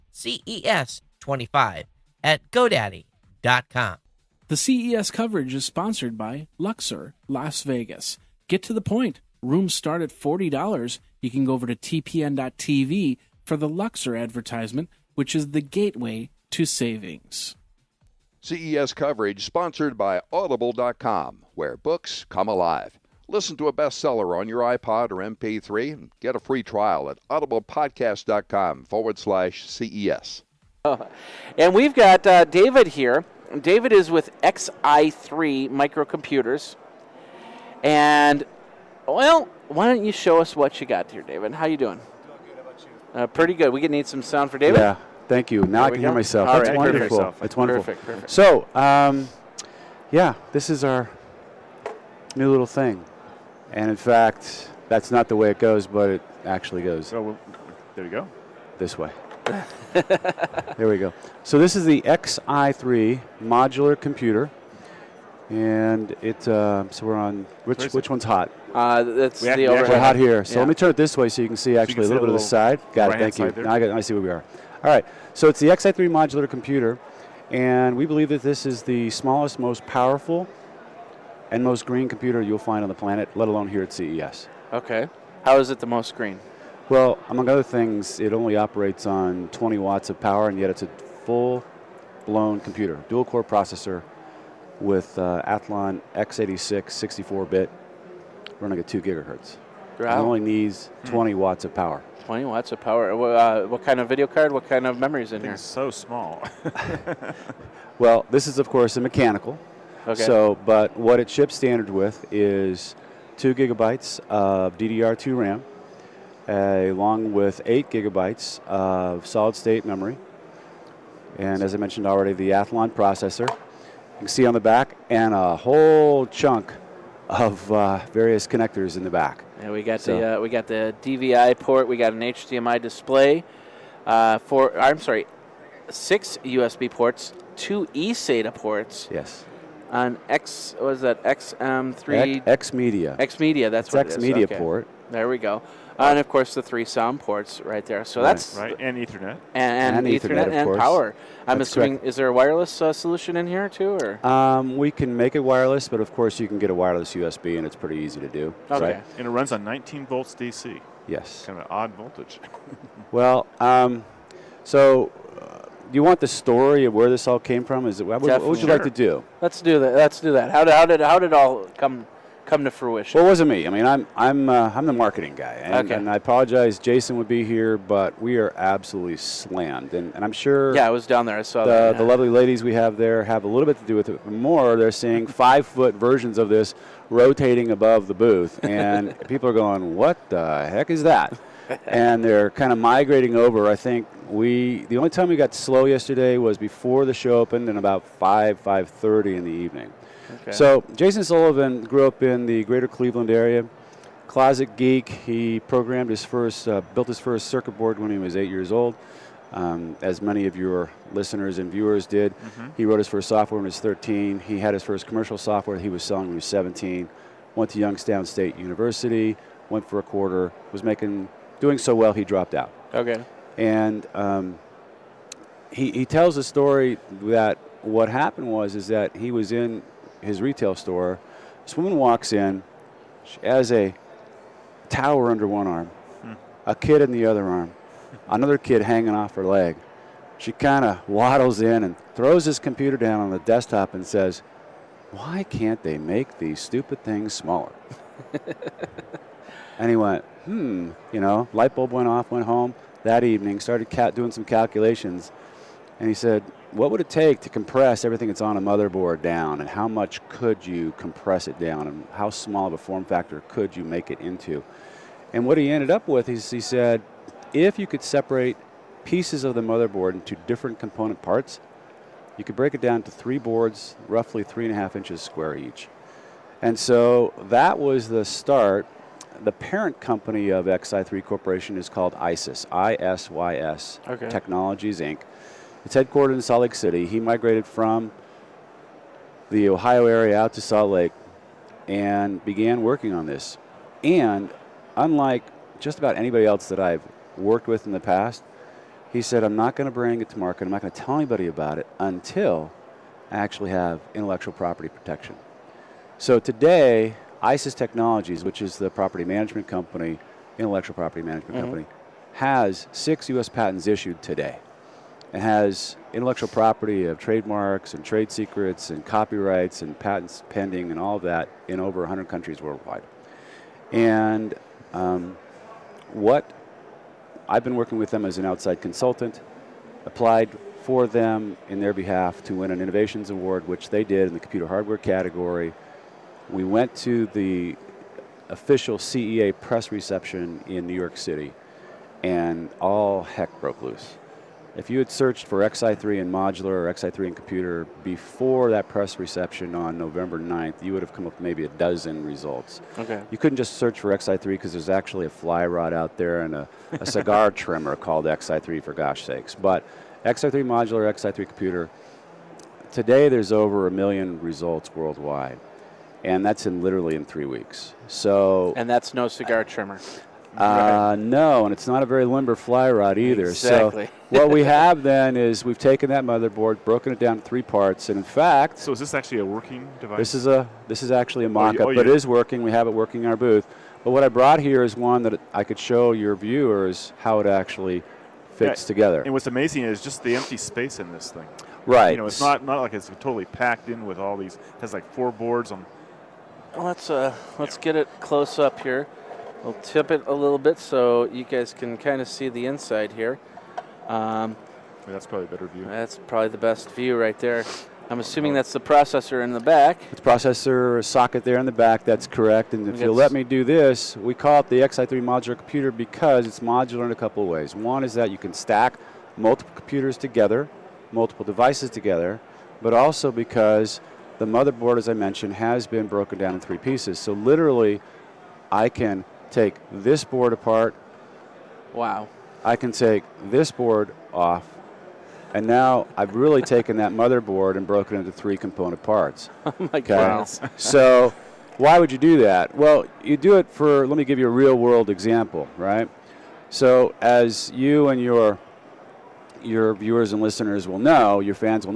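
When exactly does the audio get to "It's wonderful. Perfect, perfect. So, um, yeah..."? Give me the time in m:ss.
0:47.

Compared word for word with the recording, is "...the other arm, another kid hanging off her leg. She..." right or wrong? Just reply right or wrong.
right.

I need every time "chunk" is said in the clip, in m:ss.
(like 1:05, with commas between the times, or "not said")
2:06.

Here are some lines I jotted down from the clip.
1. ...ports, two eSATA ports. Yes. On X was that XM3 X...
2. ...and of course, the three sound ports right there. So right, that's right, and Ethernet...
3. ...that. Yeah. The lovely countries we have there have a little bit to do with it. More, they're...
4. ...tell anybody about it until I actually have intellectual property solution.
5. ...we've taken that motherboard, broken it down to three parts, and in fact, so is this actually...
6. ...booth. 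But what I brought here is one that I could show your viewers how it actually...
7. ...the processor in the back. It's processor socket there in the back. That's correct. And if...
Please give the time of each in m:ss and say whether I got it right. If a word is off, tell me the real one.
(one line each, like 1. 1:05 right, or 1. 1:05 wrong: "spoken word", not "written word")
1. 2:16 right
2. 2:26 right
3. 3:01 wrong: "ladies", not "countries"
4. 5:01 wrong: "protection", not "solution"
5. 6:15 right
6. 6:23 right
7. 6:48 right.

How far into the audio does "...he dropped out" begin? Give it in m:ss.
3:42.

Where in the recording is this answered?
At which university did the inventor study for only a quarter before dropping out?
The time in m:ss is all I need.
3:37.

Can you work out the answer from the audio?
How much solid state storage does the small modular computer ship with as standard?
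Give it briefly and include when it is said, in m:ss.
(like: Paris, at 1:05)
8 gigabytes, at 1:57.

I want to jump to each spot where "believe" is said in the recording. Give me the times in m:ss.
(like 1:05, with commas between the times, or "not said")
1:18.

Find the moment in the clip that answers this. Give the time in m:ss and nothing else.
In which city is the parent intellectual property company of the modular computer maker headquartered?
4:46.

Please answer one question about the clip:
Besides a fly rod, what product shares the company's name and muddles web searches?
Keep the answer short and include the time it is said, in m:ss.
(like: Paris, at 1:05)
cigar trimmer, at 5:57.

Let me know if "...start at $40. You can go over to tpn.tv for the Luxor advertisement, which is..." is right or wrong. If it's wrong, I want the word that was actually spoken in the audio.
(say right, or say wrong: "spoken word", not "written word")
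right.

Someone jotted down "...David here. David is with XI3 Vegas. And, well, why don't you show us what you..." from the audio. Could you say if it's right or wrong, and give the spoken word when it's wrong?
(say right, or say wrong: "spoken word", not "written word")
wrong: "Microcomputers", not "Vegas".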